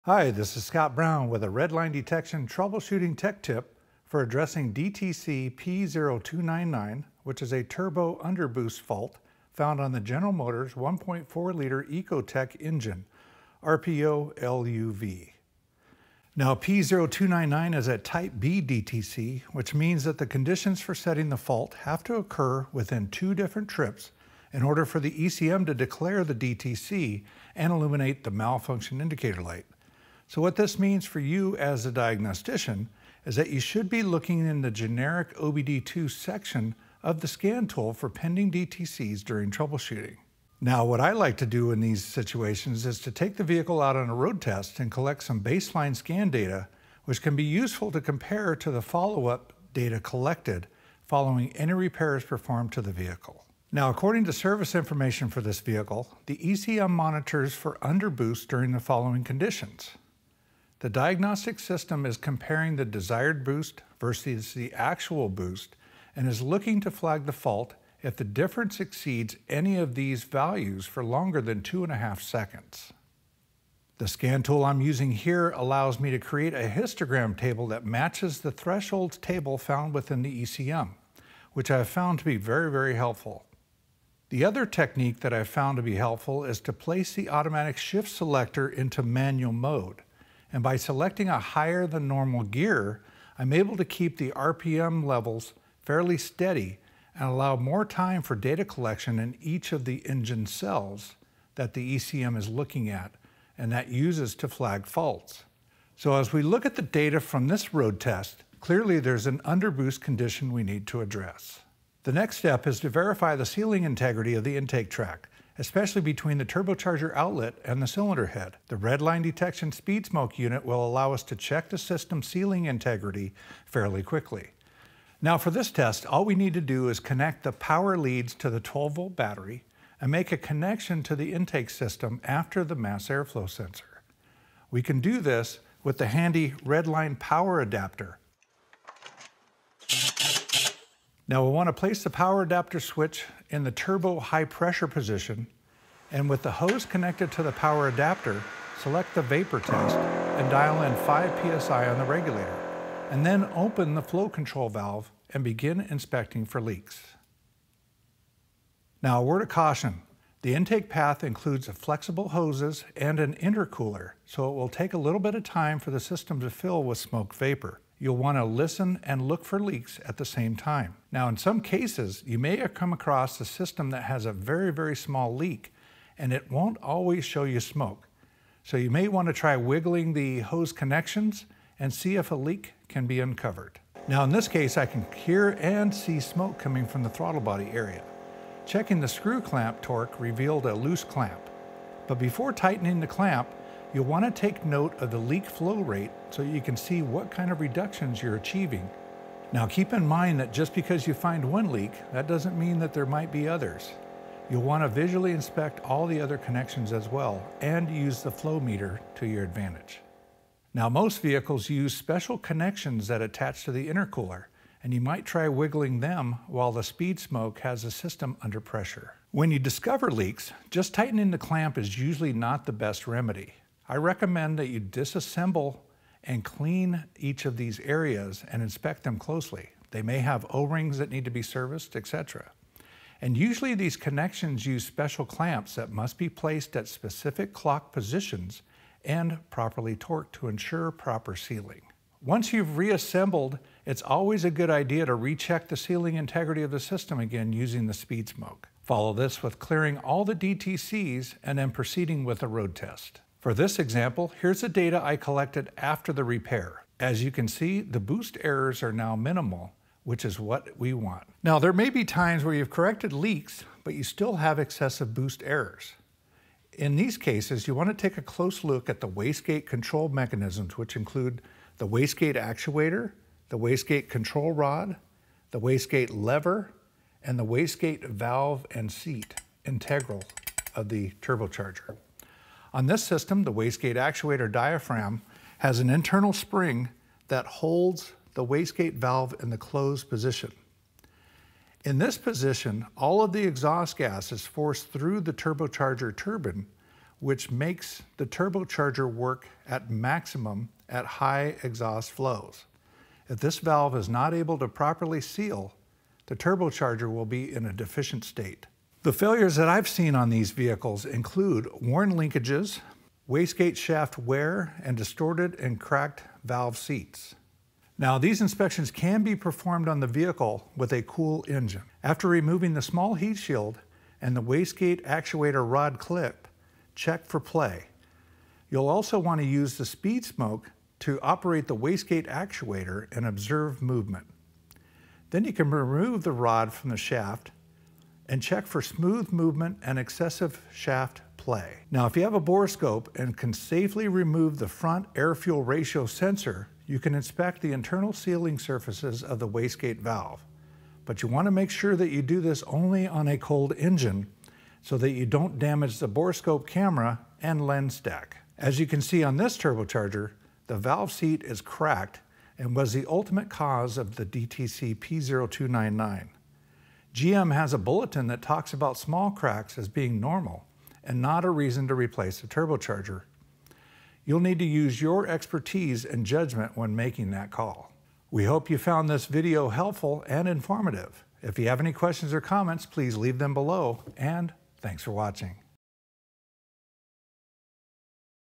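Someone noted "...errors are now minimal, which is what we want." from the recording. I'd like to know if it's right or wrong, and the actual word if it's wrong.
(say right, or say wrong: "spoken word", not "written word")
right.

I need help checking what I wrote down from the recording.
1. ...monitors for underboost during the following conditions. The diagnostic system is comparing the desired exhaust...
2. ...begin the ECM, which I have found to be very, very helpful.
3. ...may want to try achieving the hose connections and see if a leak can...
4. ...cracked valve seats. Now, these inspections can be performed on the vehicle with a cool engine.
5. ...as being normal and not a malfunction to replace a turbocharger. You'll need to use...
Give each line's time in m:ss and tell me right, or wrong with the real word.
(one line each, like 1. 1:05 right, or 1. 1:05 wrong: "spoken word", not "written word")
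1. 0:56 wrong: "boost", not "exhaust"
2. 1:19 wrong: "within", not "begin"
3. 2:58 wrong: "wiggling", not "achieving"
4. 5:15 right
5. 6:09 wrong: "reason", not "malfunction".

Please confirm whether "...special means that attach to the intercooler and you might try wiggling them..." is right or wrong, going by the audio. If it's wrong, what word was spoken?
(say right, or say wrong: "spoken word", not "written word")
wrong: "connections", not "means".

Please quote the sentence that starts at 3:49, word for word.
They may have O-rings that need to be serviced, etc.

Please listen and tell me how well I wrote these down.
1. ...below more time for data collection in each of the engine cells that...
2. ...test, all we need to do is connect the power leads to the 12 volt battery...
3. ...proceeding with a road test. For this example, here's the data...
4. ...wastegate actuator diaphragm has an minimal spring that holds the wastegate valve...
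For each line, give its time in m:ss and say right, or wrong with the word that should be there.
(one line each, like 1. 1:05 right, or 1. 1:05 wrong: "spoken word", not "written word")
1. 1:37 wrong: "allow", not "below"
2. 2:05 right
3. 4:11 right
4. 4:43 wrong: "internal", not "minimal".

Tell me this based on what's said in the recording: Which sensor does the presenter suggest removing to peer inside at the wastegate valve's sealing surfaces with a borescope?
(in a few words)
Front air-fuel ratio sensor.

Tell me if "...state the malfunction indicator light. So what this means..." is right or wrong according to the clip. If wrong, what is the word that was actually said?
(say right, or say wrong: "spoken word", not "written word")
wrong: "illuminate", not "state".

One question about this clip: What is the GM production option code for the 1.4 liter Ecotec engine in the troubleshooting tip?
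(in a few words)
LUV.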